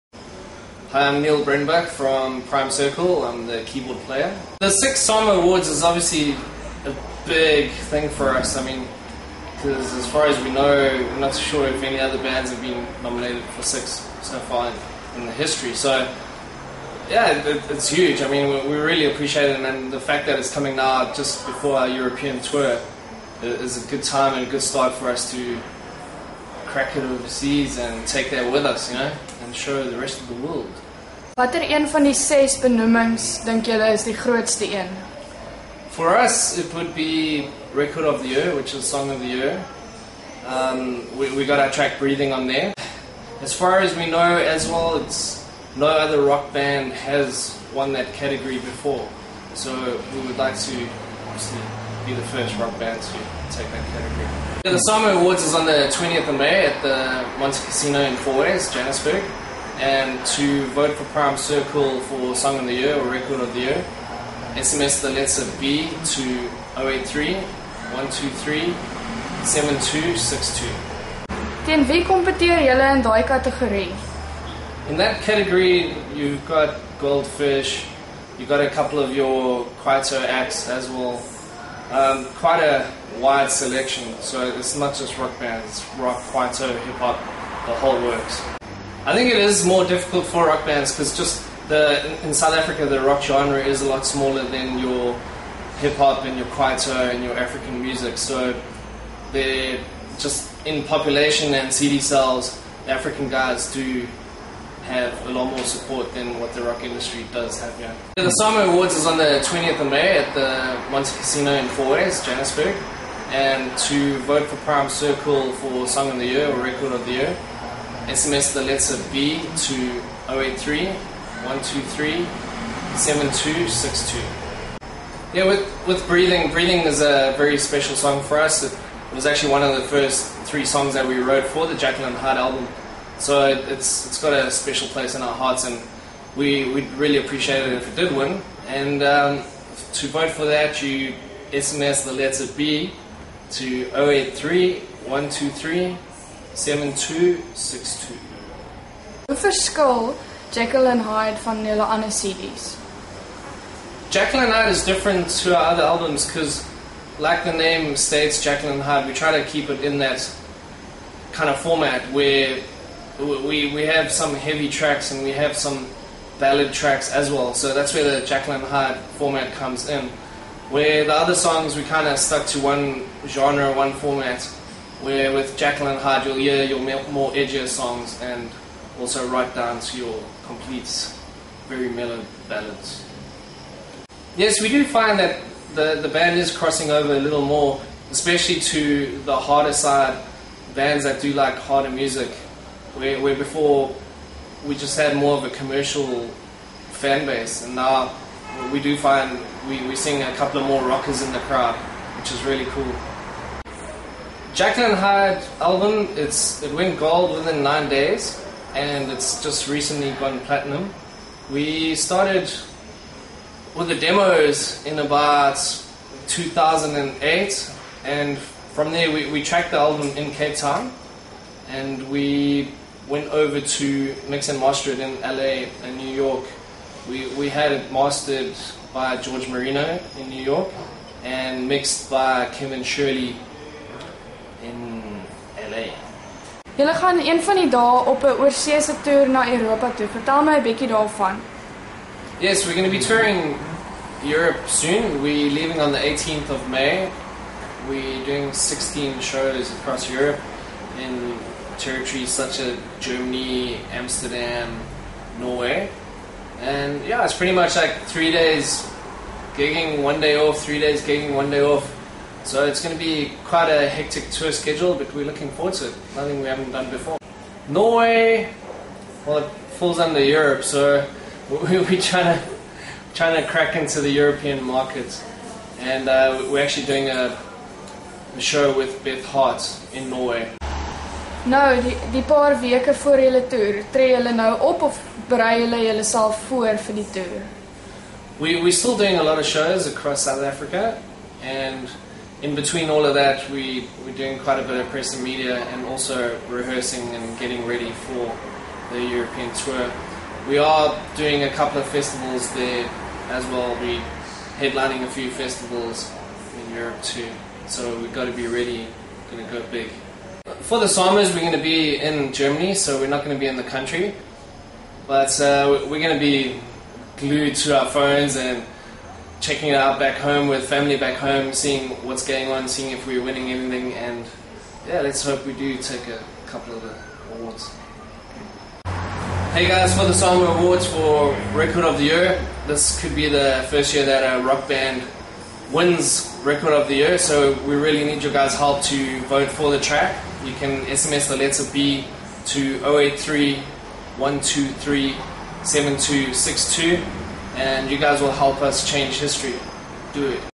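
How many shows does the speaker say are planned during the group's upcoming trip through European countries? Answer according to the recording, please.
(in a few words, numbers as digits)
16.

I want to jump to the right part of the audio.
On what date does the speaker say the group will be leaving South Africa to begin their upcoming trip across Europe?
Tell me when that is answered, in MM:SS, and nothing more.
04:05.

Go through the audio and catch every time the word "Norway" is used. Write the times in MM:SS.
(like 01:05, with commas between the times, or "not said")
04:15, 04:27, 04:40.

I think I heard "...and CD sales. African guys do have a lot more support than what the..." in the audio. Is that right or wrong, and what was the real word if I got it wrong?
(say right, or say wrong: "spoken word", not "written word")
right.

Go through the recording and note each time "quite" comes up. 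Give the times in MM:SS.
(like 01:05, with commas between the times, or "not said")
01:22, 04:23, 04:54.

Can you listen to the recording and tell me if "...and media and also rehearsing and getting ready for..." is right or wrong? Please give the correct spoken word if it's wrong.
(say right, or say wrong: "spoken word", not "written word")
right.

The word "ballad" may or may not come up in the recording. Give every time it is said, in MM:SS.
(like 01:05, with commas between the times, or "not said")
02:46, 03:02.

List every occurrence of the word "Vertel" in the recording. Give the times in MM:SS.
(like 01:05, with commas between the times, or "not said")
04:00.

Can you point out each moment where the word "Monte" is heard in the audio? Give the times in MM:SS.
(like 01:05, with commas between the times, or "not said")
00:57, 01:50.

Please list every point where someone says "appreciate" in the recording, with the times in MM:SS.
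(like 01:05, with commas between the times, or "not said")
00:19, 02:17.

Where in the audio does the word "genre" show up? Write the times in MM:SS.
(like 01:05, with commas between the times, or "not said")
01:33, 02:53.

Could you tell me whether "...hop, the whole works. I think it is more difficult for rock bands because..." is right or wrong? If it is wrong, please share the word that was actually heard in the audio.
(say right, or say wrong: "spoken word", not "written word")
right.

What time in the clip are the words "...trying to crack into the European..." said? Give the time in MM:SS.
04:33.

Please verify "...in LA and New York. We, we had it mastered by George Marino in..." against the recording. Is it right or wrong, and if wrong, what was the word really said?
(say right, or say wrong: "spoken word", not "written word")
right.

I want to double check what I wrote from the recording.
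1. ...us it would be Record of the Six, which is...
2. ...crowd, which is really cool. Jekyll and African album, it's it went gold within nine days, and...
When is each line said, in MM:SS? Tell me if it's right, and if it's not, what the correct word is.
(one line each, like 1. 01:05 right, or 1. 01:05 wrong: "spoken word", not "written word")
1. 00:36 wrong: "Year", not "Six"
2. 03:21 wrong: "Hyde", not "African".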